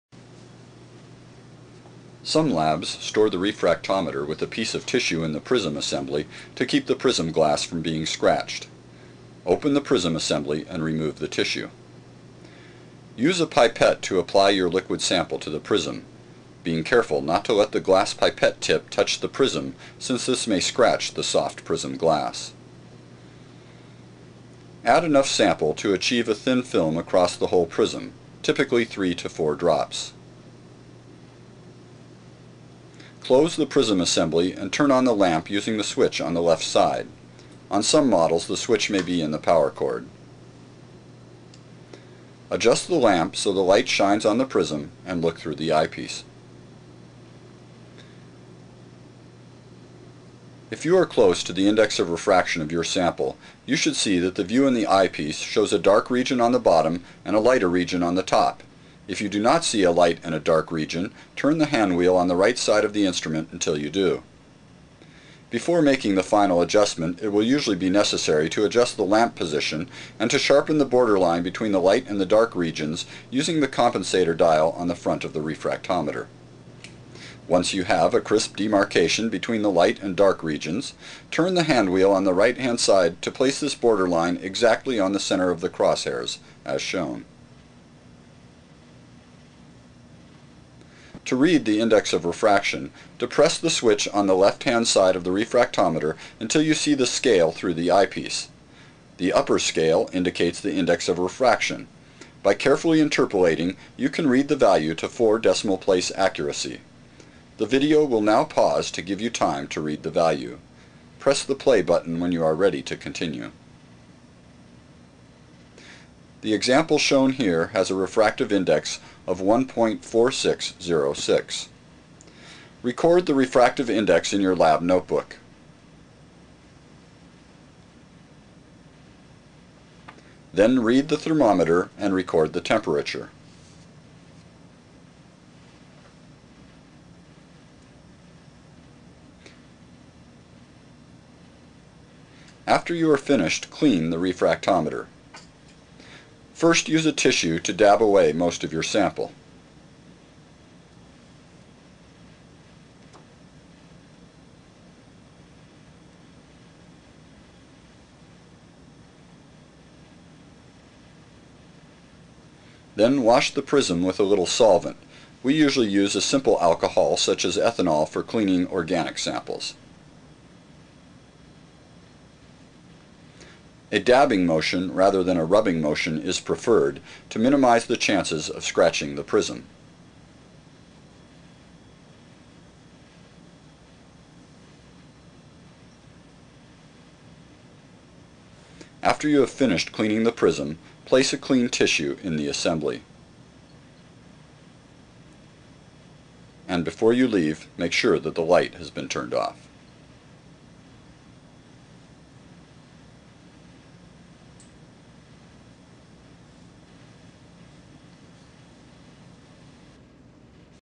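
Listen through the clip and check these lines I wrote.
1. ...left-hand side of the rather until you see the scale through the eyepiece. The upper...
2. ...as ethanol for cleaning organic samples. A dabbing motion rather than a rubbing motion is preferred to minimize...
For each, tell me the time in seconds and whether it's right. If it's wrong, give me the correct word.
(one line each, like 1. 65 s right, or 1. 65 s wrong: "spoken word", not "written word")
1. 94 s wrong: "refractometer", not "rather"
2. 167 s right.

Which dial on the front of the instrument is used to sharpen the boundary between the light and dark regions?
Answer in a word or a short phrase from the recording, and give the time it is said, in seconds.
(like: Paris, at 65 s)
compensator dial, at 73 s.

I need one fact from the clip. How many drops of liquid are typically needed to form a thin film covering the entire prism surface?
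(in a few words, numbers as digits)
3 to 4.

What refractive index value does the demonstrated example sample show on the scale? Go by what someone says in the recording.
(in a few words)
1.4606.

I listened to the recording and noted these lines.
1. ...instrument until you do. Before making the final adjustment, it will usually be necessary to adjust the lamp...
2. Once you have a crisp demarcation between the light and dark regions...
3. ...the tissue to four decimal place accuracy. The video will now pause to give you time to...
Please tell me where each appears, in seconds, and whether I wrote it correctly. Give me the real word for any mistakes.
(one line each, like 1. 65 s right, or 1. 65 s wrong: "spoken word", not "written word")
1. 63 s right
2. 77 s right
3. 104 s wrong: "value", not "tissue".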